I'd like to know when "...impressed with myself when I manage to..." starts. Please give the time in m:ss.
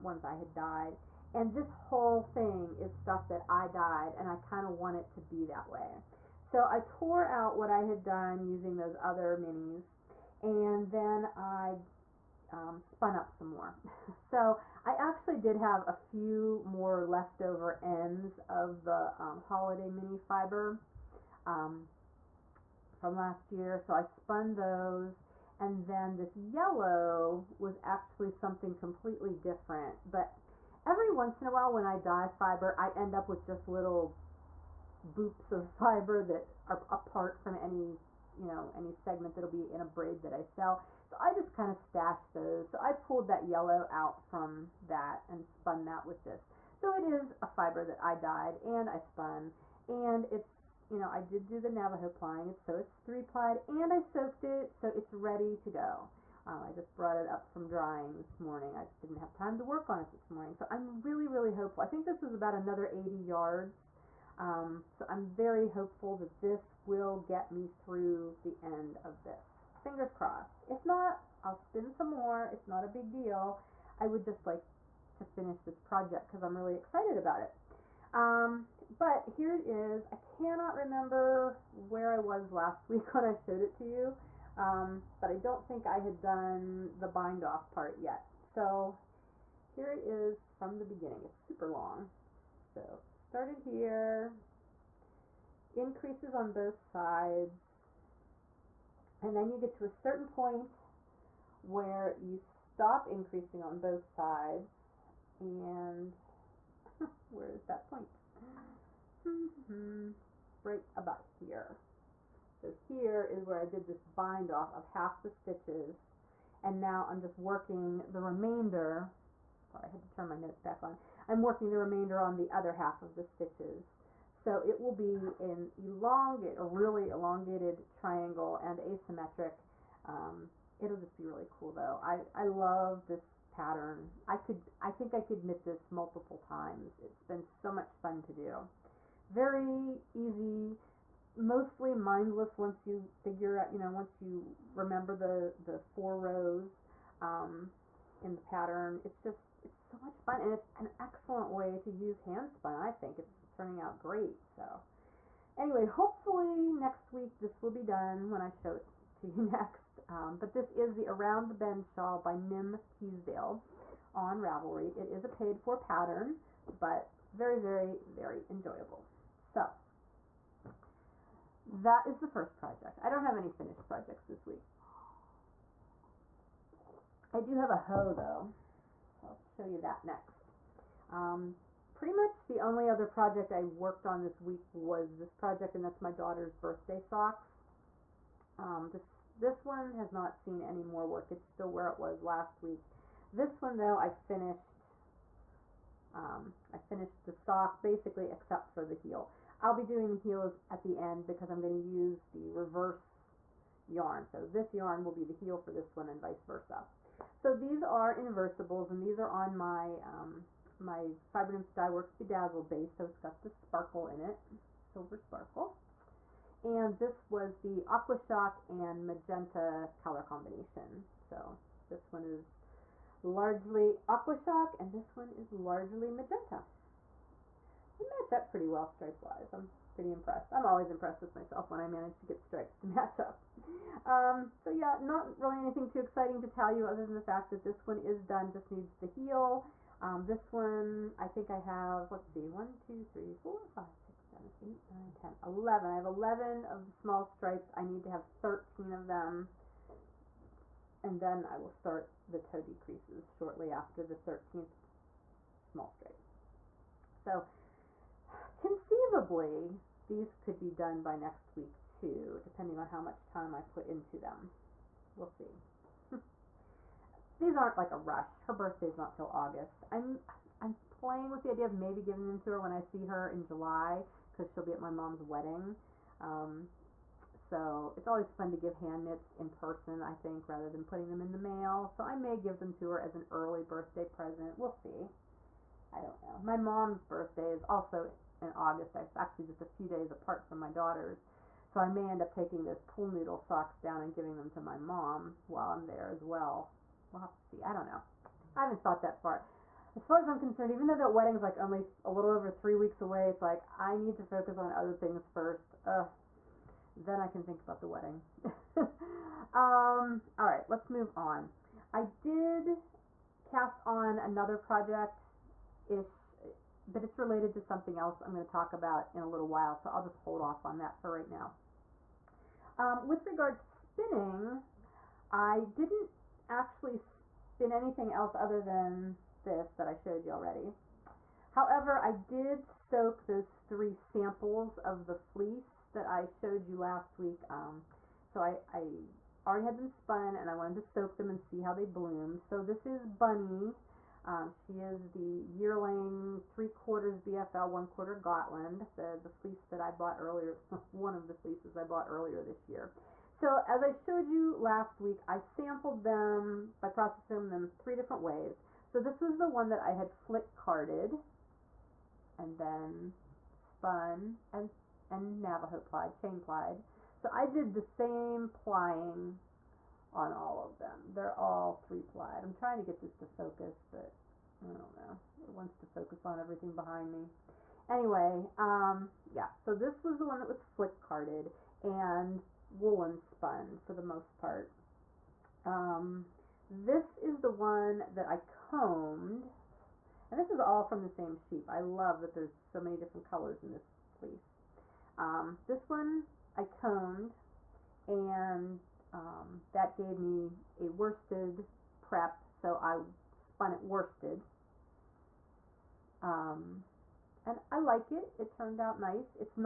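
3:50.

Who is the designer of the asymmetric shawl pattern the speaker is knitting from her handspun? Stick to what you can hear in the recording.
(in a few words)
Nim Teasdale.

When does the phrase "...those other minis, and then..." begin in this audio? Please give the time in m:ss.
0:08.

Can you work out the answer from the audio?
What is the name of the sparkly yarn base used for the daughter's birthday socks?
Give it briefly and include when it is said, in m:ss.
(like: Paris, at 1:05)
Bedazzle, at 3:32.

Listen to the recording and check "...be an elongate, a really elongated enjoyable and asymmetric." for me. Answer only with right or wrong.
wrong.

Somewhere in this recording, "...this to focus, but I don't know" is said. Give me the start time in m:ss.
6:12.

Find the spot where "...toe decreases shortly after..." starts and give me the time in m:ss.
4:12.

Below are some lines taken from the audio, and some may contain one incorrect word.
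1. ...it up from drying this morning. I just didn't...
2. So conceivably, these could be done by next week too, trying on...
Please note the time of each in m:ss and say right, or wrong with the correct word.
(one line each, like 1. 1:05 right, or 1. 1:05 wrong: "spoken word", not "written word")
1. 0:57 right
2. 4:17 wrong: "depending", not "trying".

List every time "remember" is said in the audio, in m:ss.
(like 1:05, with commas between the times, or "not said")
1:20, 2:24.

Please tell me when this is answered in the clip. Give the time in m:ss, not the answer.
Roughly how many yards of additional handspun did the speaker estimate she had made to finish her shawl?
1:02.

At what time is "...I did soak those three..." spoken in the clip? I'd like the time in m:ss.
5:32.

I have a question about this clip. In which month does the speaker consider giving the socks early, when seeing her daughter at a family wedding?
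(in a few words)
July.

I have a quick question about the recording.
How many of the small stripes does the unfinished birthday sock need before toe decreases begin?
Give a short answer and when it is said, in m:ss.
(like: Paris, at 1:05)
13, at 4:08.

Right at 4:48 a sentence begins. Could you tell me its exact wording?
It's actually just a few days apart from my daughter's.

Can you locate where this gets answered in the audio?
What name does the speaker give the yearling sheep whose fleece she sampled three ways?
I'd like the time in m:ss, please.
5:43.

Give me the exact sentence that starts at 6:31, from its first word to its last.
I love that there's so many different colors in this fleece.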